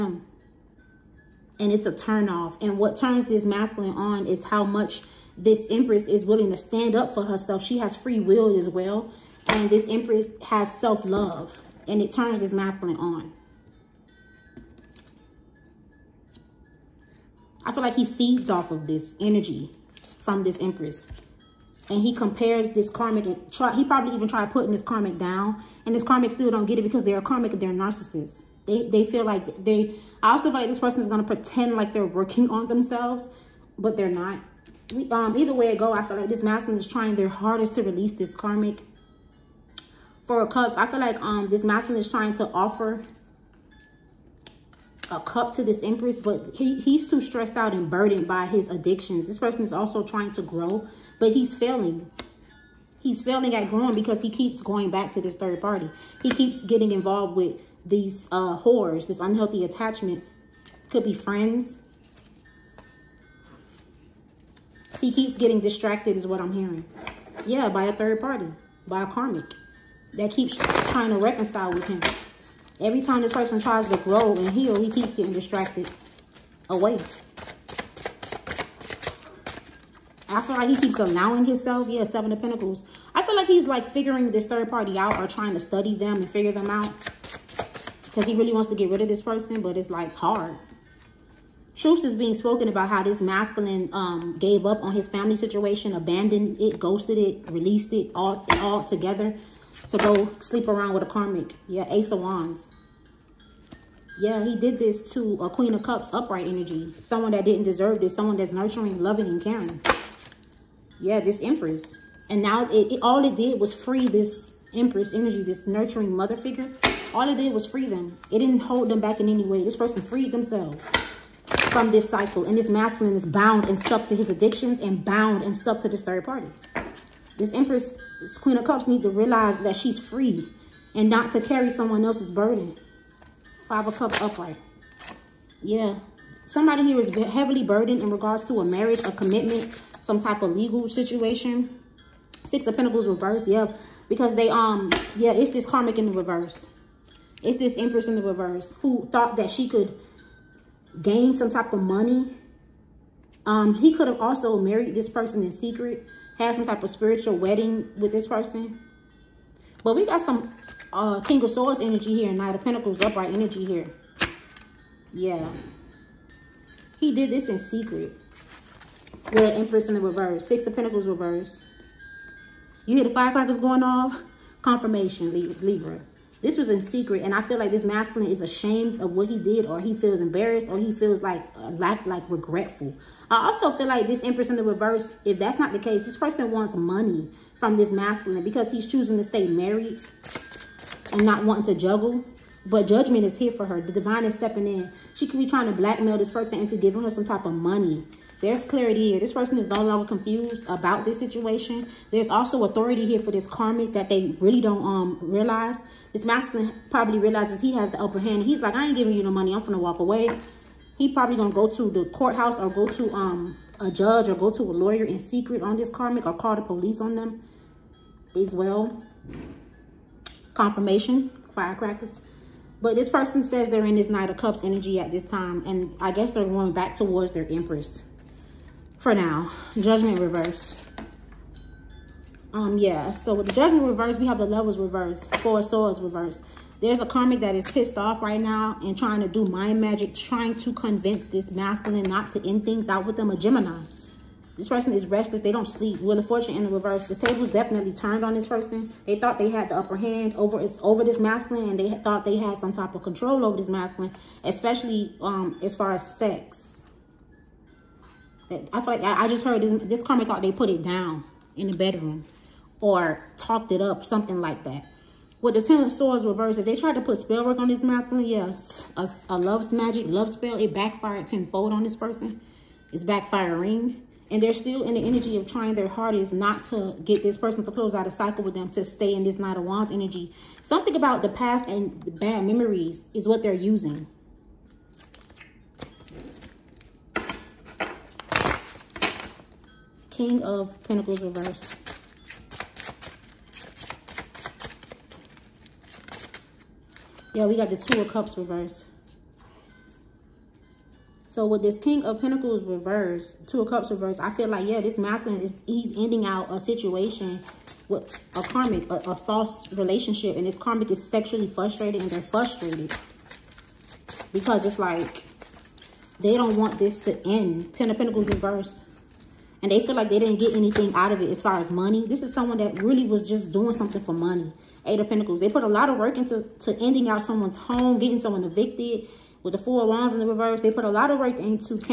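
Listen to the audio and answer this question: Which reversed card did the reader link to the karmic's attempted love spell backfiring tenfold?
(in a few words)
Ten of Swords.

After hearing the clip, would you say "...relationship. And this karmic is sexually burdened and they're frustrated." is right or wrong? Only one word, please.
wrong.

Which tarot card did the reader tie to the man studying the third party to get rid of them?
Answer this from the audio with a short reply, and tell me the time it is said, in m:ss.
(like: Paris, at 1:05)
Seven of Pentacles, at 1:22.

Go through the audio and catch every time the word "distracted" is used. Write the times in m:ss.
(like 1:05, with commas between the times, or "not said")
1:05, 1:15.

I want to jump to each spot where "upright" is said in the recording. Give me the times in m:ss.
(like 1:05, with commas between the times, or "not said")
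1:46, 2:14, 2:43.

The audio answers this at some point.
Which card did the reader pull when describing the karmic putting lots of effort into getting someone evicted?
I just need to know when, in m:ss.
5:24.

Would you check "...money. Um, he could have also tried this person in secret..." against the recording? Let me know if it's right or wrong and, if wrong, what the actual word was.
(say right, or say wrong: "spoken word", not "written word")
wrong: "married", not "tried".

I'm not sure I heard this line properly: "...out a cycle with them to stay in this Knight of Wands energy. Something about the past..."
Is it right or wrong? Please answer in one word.
right.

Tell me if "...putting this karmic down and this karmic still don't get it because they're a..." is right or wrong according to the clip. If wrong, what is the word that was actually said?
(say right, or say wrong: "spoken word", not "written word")
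right.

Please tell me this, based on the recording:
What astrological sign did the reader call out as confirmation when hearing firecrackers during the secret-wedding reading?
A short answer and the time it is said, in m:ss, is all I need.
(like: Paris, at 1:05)
Libra, at 2:55.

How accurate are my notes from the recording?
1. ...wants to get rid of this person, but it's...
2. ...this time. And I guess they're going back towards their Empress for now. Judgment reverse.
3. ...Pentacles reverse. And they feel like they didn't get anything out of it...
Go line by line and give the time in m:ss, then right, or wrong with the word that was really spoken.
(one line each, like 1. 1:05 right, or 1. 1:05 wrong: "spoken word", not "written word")
1. 1:28 right
2. 3:45 right
3. 5:17 right.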